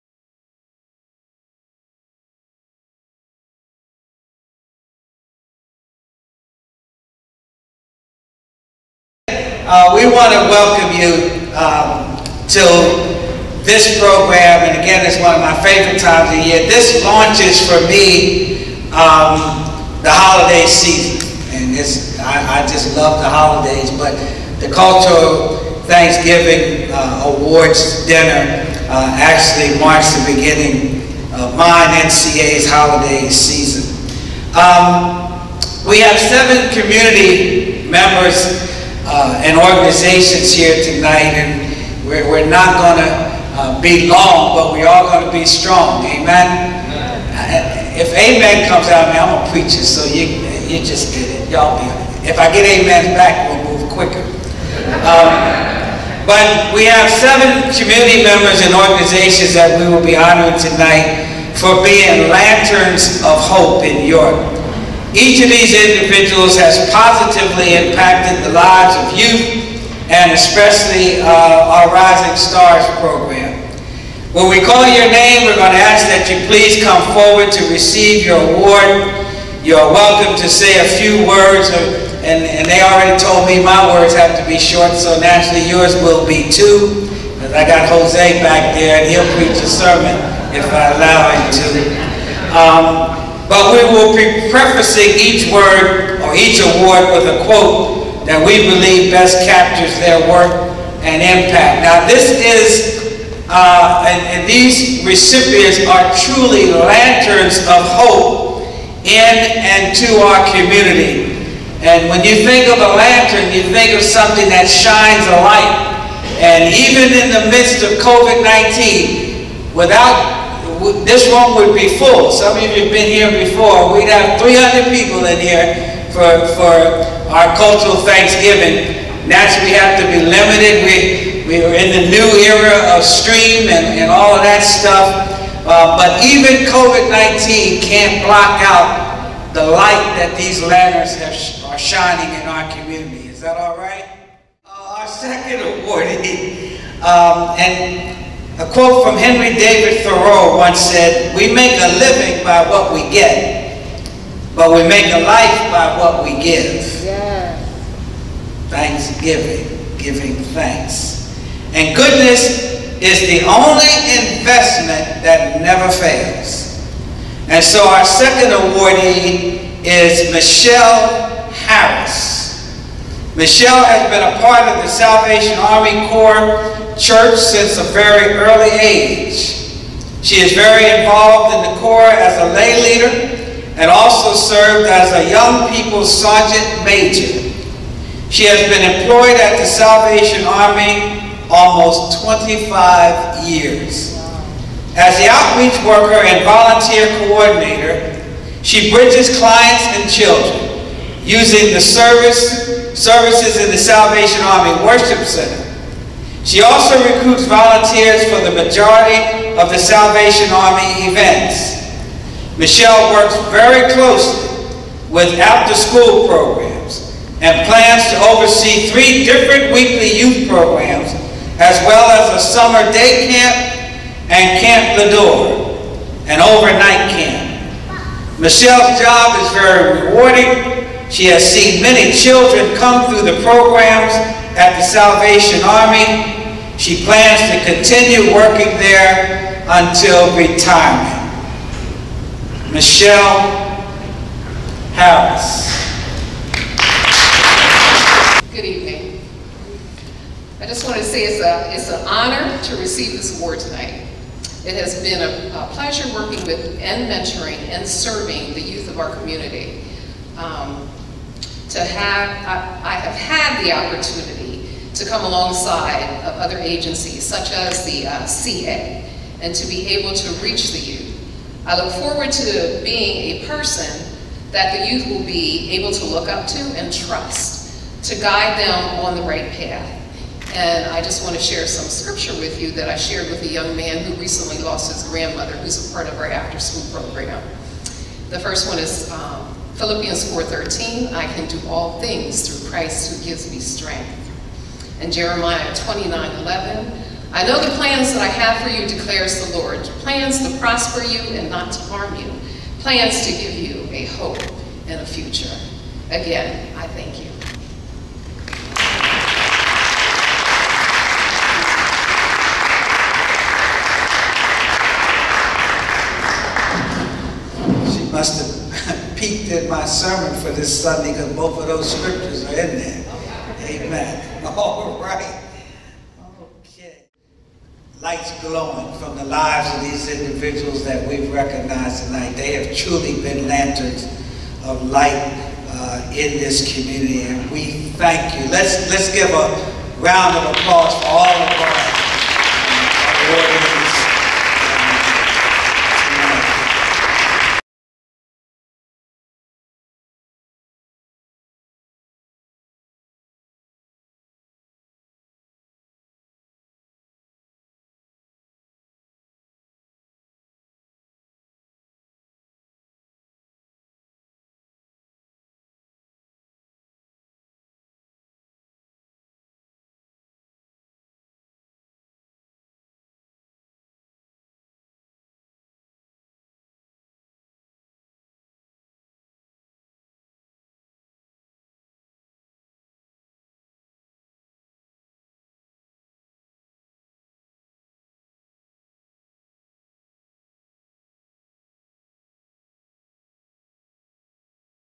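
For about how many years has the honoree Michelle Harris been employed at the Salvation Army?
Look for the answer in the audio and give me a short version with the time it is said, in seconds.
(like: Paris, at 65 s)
25, at 192 s.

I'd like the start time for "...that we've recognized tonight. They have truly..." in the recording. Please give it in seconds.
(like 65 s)
330 s.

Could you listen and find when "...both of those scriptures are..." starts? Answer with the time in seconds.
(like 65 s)
321 s.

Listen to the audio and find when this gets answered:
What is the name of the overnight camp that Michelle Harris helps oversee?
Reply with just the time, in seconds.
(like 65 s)
224 s.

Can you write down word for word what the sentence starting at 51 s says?
Y'all be If I get amen back, we'll move quicker.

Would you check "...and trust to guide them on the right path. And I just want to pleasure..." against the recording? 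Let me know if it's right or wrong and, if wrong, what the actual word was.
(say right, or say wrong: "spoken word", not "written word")
wrong: "share", not "pleasure".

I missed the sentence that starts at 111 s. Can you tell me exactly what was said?
And when you think of a lantern, you think of something that shines a light.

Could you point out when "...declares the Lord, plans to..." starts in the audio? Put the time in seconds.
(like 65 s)
298 s.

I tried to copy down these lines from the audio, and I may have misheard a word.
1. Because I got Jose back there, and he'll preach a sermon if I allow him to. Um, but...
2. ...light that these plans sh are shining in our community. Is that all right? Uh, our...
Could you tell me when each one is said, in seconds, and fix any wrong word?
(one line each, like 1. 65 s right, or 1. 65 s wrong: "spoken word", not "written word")
1. 87 s right
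2. 139 s wrong: "lanterns", not "plans".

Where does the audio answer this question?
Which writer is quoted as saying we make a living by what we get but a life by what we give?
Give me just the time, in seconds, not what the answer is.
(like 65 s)
149 s.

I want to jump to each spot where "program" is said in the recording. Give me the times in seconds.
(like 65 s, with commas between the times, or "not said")
14 s, 73 s, 216 s, 220 s, 233 s, 286 s.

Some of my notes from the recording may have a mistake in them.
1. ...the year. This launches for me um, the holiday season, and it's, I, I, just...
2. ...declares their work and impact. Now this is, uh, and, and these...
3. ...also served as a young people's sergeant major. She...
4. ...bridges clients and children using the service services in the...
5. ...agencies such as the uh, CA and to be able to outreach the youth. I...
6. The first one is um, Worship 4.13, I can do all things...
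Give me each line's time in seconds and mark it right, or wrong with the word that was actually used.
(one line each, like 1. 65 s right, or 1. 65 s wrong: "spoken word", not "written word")
1. 16 s right
2. 99 s wrong: "captures", not "declares"
3. 183 s right
4. 198 s right
5. 266 s wrong: "reach", not "outreach"
6. 288 s wrong: "Philippians", not "Worship".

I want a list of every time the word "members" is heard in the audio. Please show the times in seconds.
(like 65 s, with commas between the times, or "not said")
37 s, 58 s.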